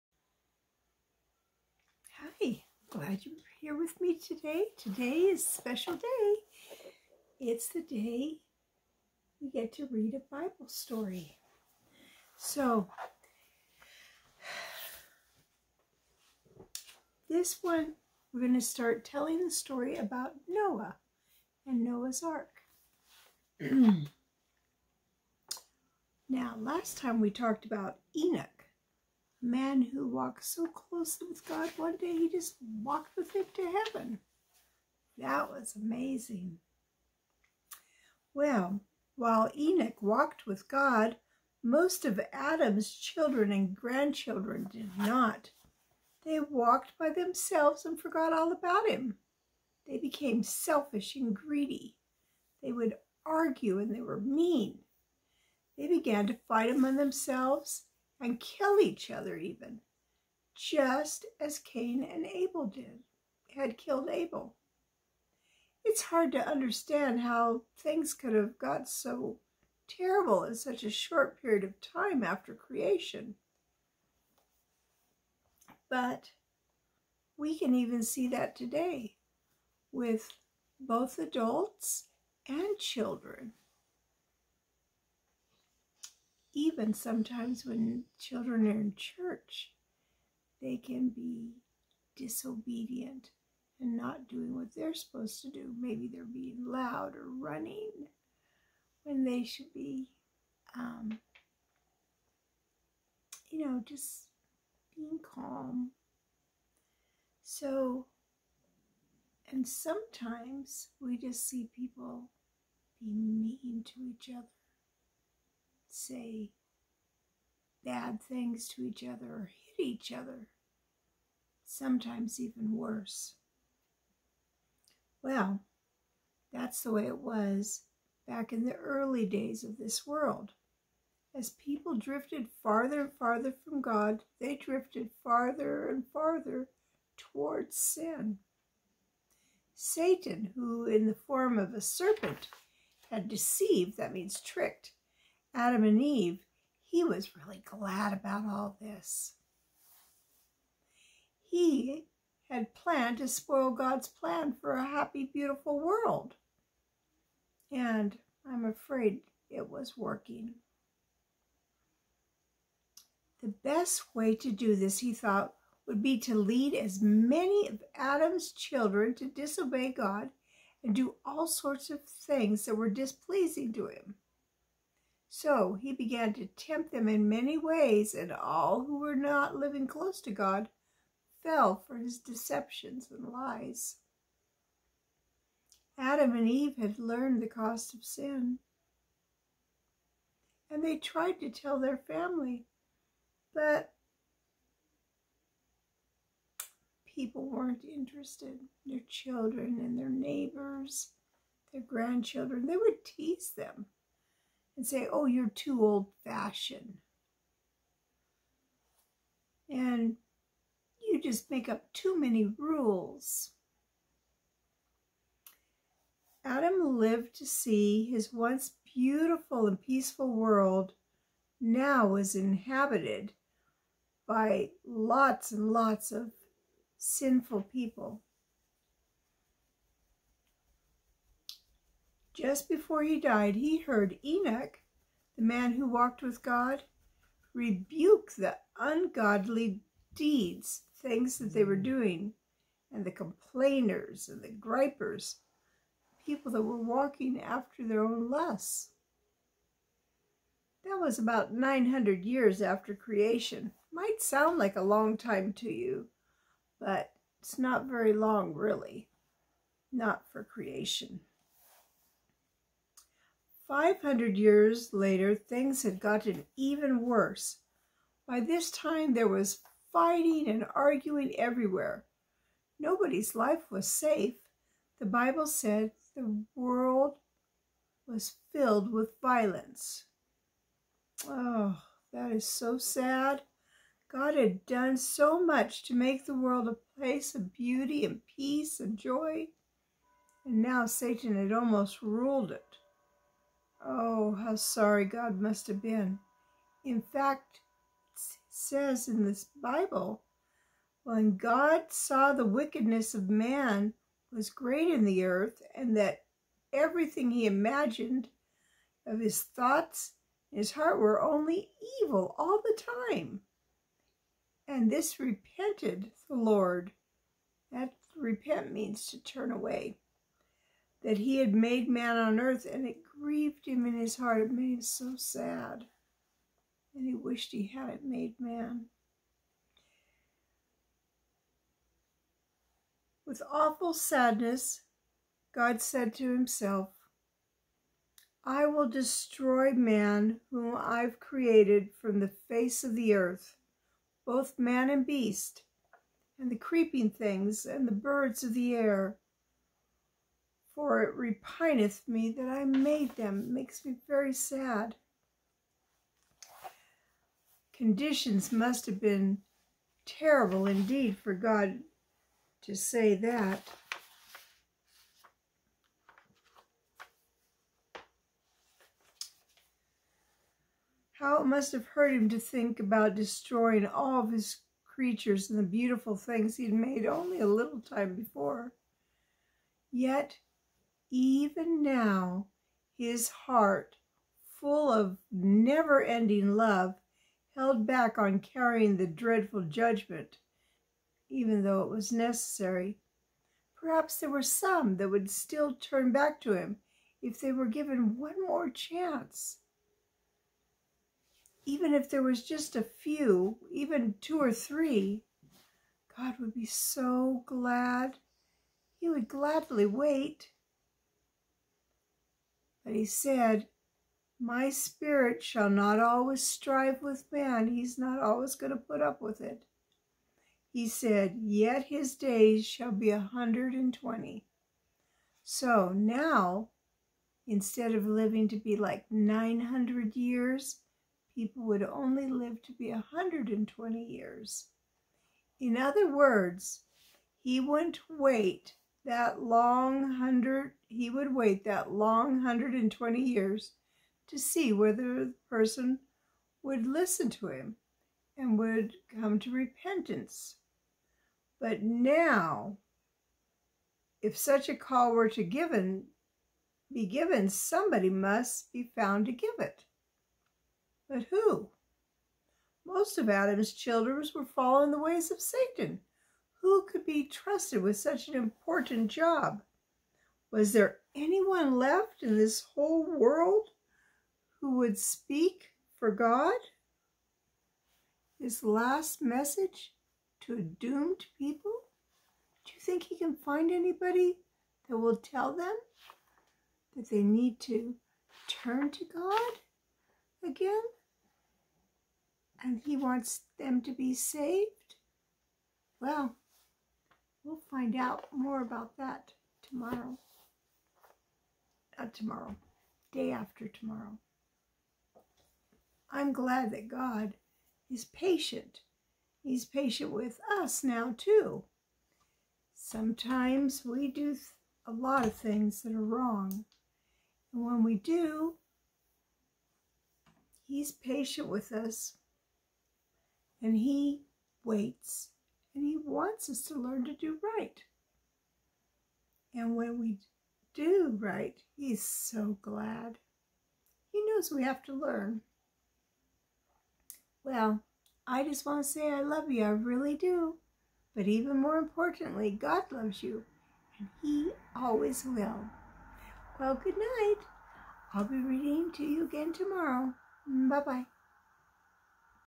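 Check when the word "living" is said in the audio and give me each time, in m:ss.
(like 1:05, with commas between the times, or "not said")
2:59, 7:08.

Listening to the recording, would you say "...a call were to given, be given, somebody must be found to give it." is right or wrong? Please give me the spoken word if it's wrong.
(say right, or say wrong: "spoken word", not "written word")
right.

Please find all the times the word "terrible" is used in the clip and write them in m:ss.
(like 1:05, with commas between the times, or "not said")
1:09, 6:00.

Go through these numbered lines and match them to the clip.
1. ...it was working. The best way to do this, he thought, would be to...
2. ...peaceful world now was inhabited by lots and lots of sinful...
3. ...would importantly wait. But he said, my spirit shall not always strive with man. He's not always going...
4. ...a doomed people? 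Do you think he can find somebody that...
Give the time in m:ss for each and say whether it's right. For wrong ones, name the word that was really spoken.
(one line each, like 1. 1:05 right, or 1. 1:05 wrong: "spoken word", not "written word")
1. 2:39 right
2. 3:39 right
3. 6:49 wrong: "gladly", not "importantly"
4. 8:00 wrong: "anybody", not "somebody".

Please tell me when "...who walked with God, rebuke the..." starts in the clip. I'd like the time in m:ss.
3:55.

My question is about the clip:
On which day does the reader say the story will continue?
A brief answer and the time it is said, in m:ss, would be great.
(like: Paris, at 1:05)
day after tomorrow, at 8:23.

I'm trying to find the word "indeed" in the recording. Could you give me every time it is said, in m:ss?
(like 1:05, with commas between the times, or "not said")
6:00.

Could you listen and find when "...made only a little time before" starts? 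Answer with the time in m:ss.
6:16.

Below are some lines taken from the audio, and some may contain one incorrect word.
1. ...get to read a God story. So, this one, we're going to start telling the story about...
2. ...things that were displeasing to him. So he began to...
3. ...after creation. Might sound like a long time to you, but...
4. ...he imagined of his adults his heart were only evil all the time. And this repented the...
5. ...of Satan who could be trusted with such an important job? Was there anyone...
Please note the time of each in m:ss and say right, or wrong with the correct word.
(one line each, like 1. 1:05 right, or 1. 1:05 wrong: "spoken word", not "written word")
1. 0:09 wrong: "Bible", not "God"
2. 2:52 right
3. 4:12 right
4. 5:07 wrong: "thoughts", not "adults"
5. 7:45 right.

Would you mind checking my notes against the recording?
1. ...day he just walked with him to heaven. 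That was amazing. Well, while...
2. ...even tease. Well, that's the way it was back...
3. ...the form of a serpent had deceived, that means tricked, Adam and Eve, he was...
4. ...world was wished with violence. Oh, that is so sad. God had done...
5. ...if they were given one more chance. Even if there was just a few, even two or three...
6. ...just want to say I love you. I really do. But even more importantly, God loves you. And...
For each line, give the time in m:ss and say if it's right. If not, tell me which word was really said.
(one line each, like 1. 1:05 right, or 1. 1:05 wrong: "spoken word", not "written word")
1. 0:31 right
2. 2:02 wrong: "worse", not "tease"
3. 2:21 right
4. 4:36 wrong: "filled", not "wished"
5. 6:37 right
6. 8:58 right.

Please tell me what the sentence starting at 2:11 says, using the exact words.
As people drifted farther and farther from God, they drifted farther and farther towards sin.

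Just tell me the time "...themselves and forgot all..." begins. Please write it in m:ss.
0:47.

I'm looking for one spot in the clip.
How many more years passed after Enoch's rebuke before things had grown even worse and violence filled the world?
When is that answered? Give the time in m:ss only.
4:23.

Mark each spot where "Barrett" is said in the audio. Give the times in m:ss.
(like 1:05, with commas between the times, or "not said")
not said.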